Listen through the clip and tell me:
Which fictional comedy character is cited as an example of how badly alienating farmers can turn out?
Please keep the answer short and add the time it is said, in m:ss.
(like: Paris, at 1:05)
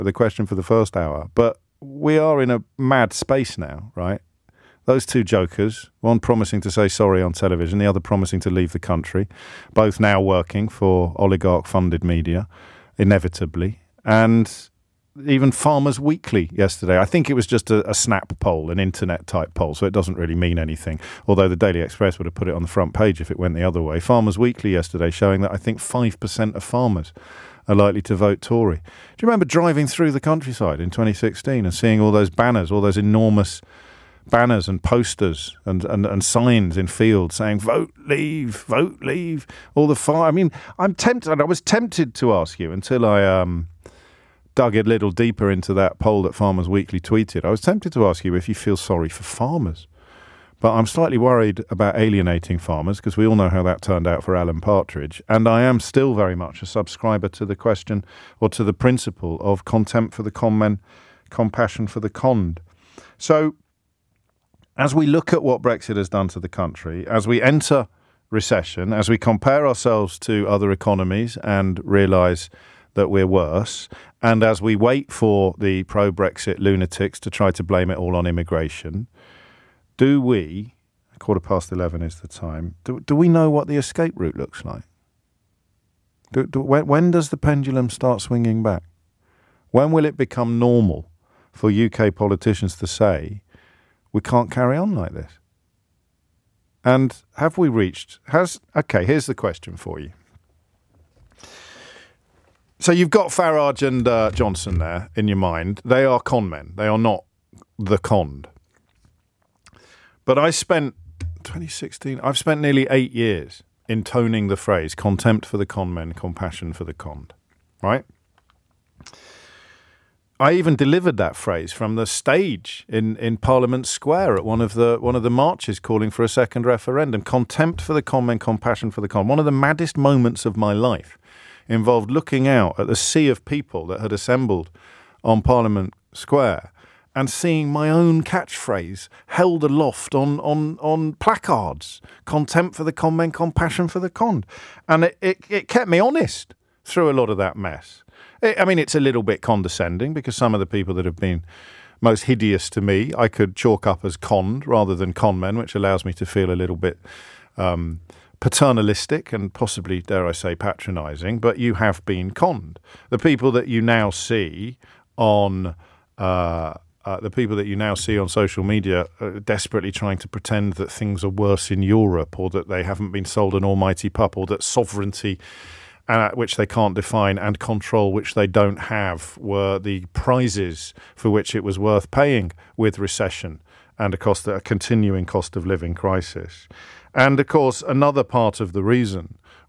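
Alan Partridge, at 0:54.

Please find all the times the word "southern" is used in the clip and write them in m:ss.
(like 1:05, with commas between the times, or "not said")
not said.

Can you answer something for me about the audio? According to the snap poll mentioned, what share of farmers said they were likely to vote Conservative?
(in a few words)
5%.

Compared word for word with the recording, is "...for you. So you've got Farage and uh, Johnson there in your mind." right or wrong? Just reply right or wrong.
right.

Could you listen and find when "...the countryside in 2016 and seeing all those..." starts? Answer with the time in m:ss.
0:30.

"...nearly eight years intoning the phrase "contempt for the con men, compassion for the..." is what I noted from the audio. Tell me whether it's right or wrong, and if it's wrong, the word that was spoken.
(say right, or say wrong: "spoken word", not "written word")
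right.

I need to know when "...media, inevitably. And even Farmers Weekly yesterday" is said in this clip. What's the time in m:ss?
0:12.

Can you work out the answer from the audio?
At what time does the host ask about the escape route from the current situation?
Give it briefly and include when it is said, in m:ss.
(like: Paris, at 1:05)
quarter past 11, at 1:21.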